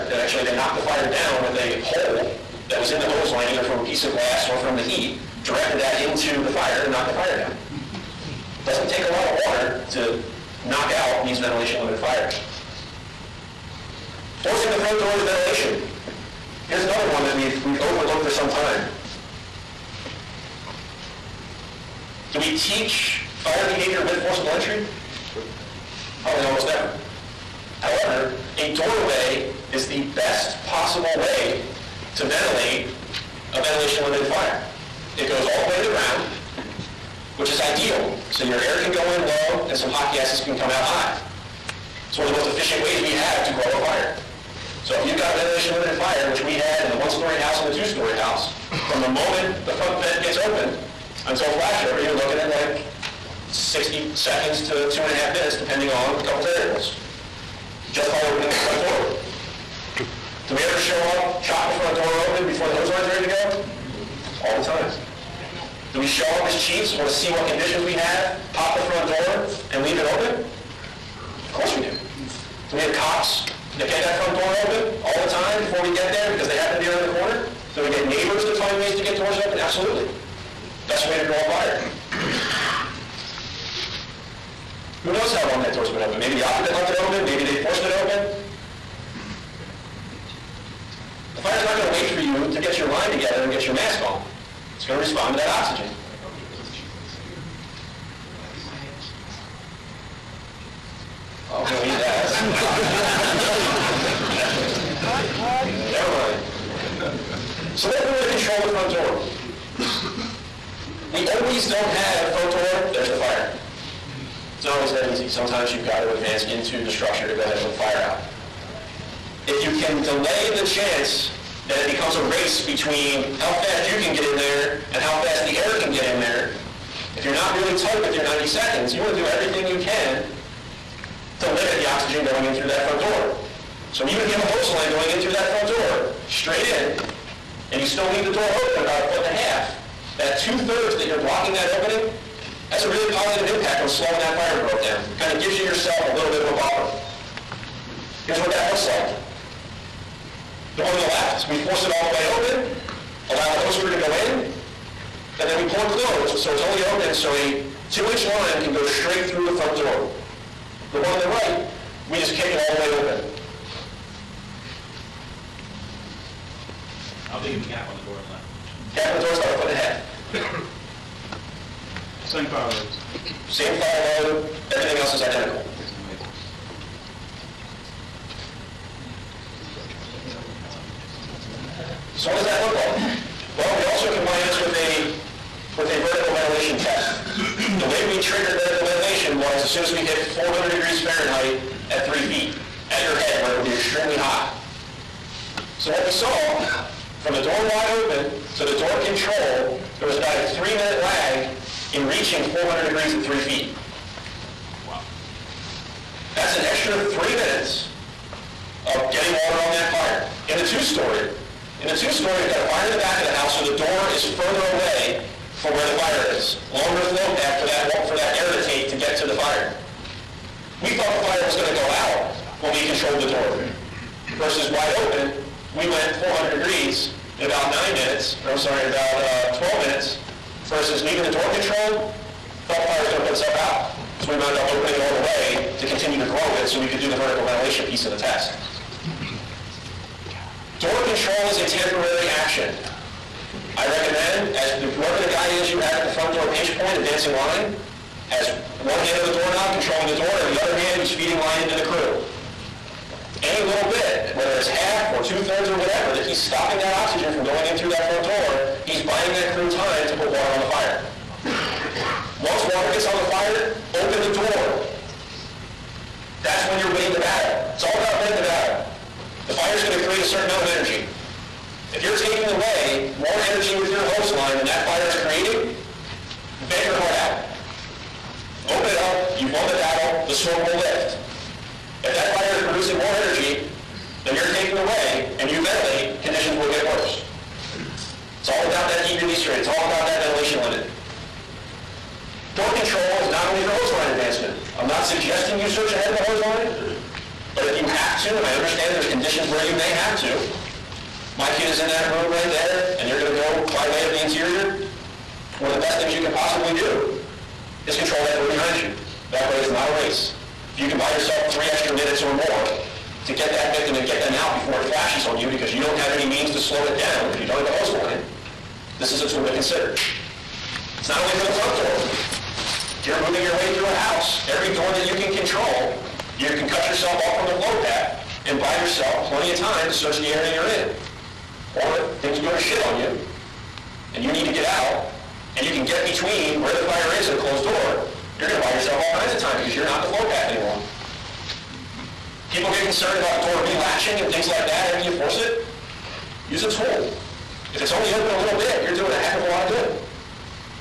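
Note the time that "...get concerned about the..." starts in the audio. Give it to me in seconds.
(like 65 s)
342 s.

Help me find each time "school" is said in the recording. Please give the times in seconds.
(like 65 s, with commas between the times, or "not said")
not said.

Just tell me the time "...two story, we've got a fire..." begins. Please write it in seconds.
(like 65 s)
211 s.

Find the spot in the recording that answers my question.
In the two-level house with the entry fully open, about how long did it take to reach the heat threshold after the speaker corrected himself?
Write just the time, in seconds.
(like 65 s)
229 s.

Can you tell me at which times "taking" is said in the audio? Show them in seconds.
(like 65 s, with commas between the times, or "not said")
272 s, 284 s.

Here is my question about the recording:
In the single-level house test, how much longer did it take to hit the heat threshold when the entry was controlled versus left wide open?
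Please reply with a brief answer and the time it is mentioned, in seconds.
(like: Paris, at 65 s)
3 minutes, at 200 s.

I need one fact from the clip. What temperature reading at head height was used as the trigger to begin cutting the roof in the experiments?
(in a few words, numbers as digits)
400 degrees Fahrenheit.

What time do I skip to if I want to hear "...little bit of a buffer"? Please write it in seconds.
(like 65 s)
146 s.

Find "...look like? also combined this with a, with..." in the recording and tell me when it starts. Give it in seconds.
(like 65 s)
182 s.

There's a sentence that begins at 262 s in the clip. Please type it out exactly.
Once water gets on the fire, open the door.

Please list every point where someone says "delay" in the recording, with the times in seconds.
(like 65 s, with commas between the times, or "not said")
120 s.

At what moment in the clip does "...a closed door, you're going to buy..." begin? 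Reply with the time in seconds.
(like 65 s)
337 s.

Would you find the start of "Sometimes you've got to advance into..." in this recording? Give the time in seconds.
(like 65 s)
115 s.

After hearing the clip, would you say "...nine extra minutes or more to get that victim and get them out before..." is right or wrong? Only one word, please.
wrong.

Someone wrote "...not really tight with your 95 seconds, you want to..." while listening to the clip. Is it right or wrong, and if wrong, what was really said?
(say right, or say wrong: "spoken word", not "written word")
wrong: "90", not "95".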